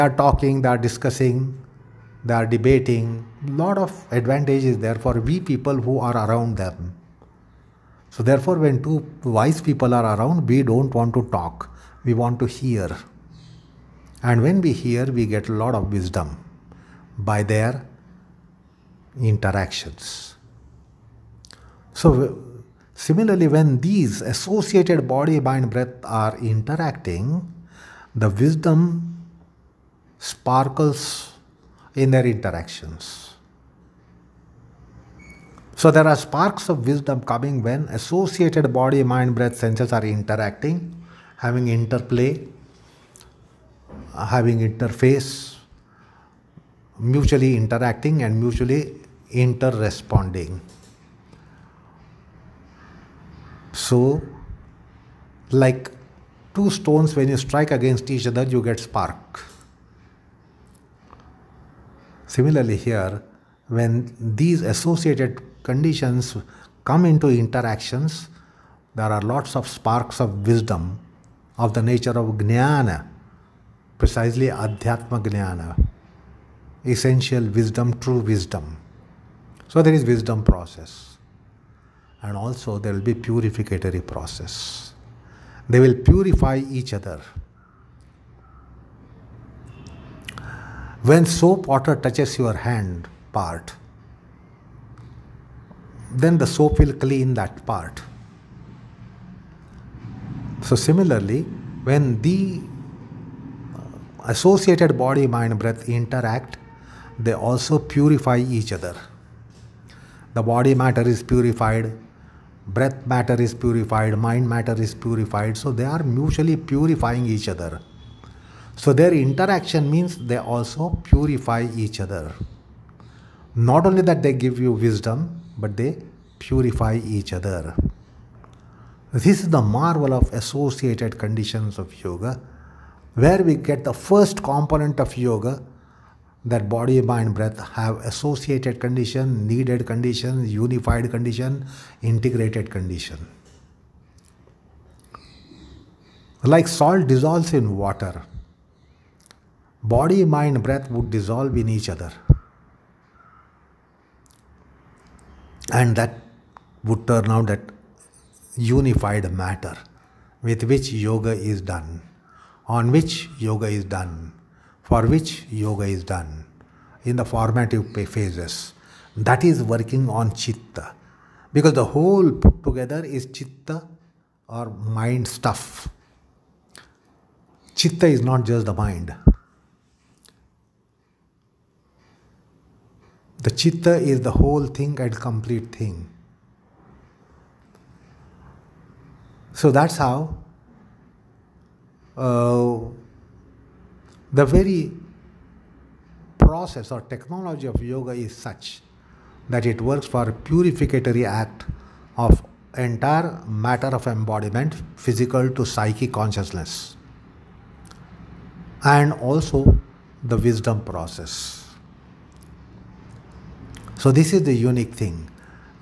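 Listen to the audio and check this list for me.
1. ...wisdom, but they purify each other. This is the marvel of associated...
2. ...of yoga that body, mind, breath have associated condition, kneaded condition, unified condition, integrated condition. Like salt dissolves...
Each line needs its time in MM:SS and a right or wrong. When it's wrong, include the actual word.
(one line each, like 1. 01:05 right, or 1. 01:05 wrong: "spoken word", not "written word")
1. 02:04 right
2. 02:14 right.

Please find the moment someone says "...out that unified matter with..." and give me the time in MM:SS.
02:37.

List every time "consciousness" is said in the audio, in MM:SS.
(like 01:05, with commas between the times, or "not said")
03:26.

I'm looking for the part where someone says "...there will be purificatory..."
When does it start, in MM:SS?
01:22.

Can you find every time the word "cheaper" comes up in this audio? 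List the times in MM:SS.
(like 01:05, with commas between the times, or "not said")
not said.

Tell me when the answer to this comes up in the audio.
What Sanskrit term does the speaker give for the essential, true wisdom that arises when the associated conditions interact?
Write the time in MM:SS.
01:14.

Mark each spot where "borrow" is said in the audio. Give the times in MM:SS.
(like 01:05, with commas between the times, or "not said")
not said.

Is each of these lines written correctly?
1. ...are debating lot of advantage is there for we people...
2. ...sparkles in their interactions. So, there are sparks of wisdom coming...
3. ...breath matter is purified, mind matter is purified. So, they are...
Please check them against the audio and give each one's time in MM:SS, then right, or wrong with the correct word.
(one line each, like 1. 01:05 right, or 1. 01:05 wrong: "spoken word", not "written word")
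1. 00:02 right
2. 00:30 right
3. 01:52 right.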